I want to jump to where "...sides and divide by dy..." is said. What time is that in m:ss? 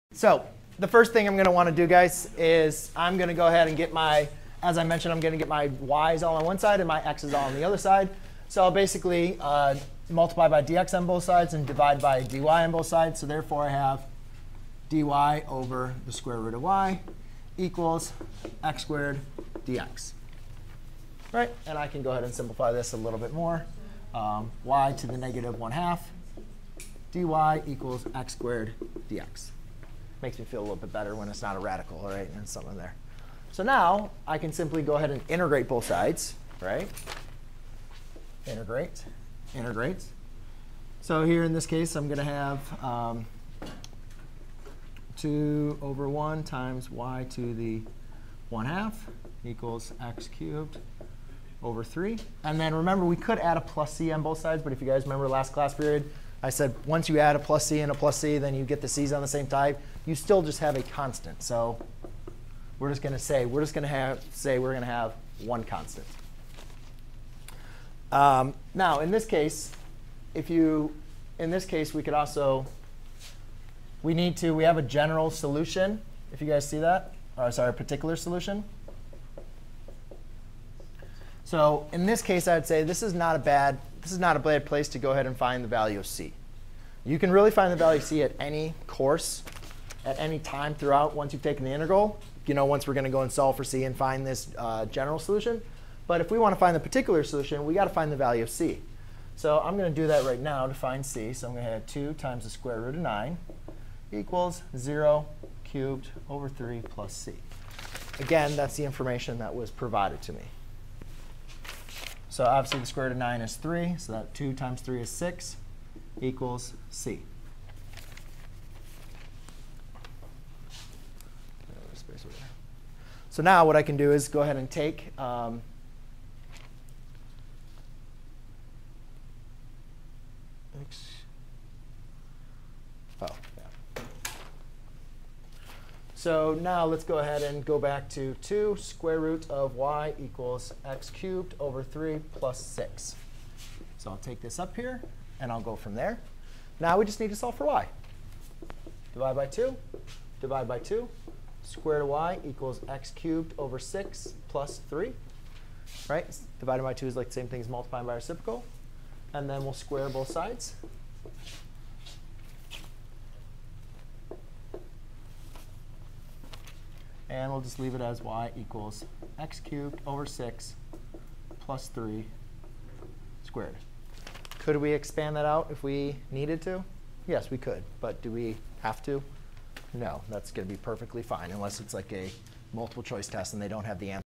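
0:11.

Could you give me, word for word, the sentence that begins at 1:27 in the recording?
You can really find the value of c at any course, at any time throughout once you've taken the integral.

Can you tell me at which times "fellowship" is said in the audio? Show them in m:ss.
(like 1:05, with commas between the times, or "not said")
not said.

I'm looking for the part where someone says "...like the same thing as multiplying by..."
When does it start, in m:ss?
2:37.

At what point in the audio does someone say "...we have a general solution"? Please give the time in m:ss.
1:14.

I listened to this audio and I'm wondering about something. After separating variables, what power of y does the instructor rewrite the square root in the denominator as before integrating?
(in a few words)
negative 1/2.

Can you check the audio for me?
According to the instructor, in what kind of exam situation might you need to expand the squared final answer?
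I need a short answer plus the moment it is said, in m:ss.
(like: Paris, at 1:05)
multiple choice test, at 3:02.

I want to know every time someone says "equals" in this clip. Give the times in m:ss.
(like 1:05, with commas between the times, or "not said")
0:17, 0:27, 0:49, 1:44, 1:56, 2:20, 2:32, 2:48.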